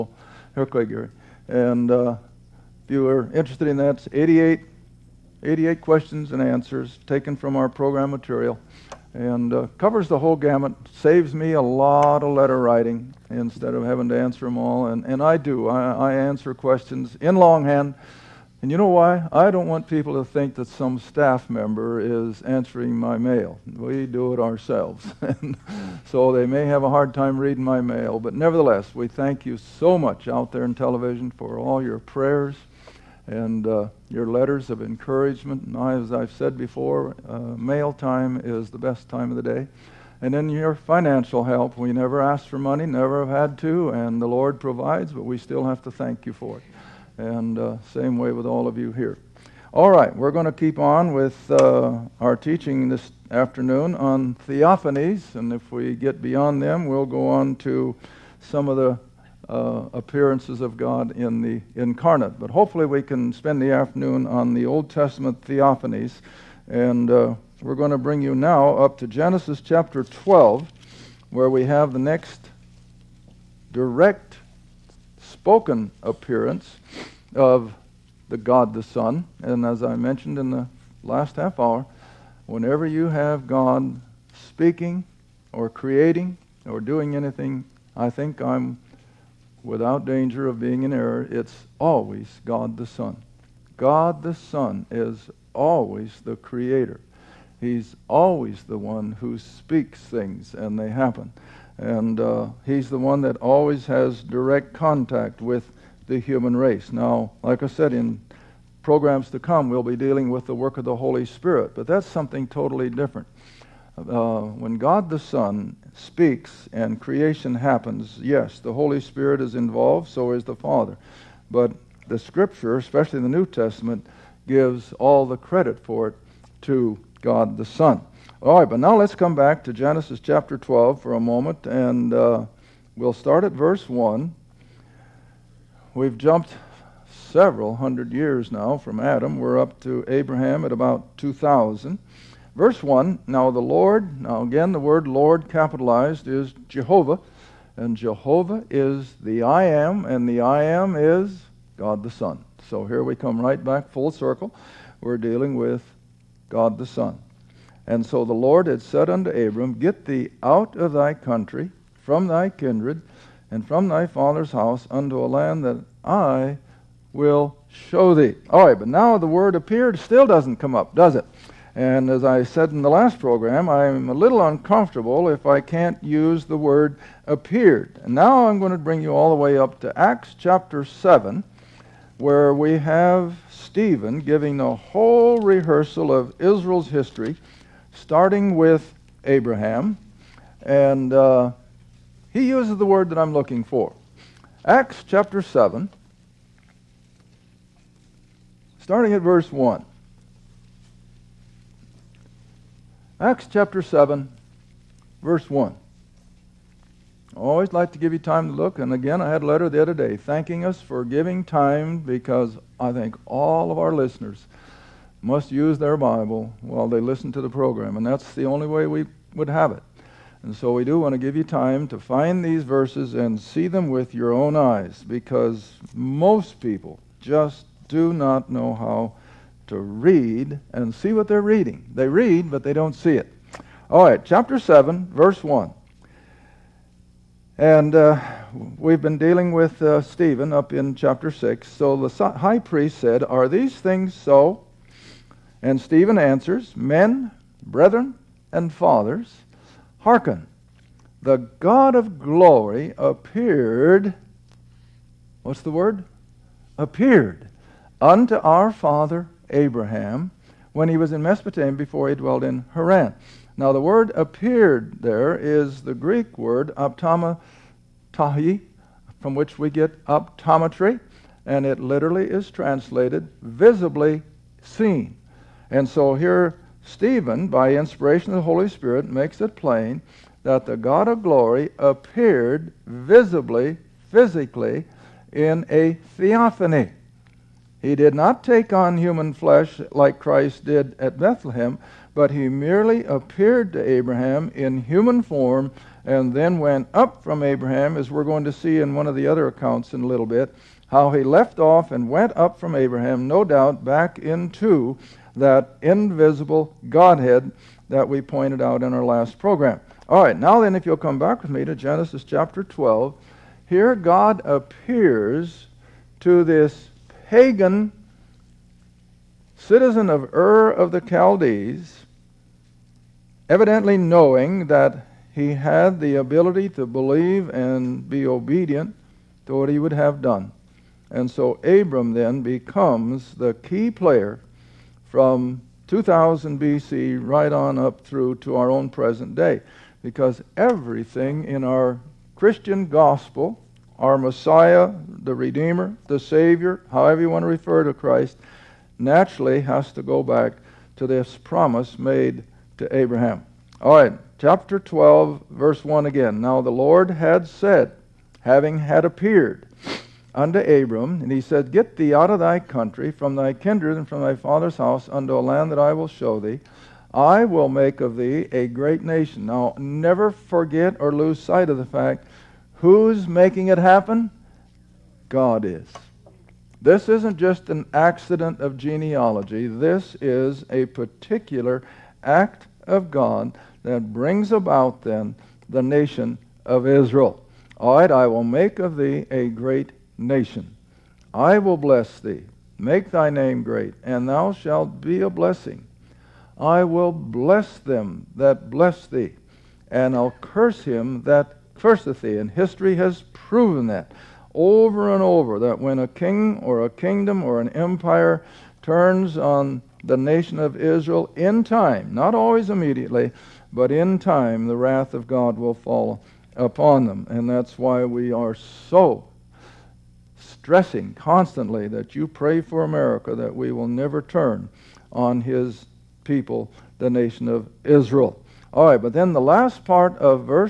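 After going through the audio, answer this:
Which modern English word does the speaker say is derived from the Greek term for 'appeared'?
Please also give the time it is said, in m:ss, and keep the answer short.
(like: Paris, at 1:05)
optometry, at 4:30.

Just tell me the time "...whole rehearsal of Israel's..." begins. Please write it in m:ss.
3:04.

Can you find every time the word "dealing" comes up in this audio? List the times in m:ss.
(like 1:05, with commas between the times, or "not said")
1:49, 2:35, 3:59.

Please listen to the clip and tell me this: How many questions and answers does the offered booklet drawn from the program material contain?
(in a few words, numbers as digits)
88.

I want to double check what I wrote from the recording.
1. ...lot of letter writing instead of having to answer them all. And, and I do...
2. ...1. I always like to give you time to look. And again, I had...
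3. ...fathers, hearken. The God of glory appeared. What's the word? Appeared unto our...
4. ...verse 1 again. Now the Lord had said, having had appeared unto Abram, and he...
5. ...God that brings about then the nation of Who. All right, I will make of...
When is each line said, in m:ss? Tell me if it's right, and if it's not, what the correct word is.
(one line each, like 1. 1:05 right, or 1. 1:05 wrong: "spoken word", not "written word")
1. 0:11 right
2. 3:25 right
3. 4:08 right
4. 5:55 right
5. 6:23 wrong: "Israel", not "Who".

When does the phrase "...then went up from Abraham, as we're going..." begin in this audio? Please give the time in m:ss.
4:56.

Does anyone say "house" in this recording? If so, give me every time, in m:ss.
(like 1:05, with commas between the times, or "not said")
2:44, 6:04.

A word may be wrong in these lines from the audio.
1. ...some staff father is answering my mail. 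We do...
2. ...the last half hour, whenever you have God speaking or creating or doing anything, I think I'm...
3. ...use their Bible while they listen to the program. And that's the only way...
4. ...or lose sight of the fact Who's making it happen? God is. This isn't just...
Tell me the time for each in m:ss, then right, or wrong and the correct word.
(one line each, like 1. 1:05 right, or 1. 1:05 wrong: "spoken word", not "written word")
1. 0:20 wrong: "member", not "father"
2. 1:20 right
3. 3:35 right
4. 6:10 right.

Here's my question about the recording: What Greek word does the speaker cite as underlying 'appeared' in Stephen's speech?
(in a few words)
optomatahi.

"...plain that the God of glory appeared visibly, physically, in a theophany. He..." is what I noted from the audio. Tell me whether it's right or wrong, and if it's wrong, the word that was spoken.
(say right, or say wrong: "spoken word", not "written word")
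right.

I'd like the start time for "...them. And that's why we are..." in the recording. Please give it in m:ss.
6:57.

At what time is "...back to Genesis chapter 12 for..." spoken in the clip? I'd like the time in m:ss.
2:09.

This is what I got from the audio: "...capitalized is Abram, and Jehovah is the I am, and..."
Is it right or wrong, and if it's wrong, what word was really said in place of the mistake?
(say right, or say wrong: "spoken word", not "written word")
wrong: "Jehovah", not "Abram".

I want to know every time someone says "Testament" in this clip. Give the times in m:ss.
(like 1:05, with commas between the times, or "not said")
1:04, 2:03.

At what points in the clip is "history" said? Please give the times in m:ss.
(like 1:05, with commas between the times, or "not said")
3:06, 6:42.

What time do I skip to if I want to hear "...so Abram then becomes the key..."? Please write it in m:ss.
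5:31.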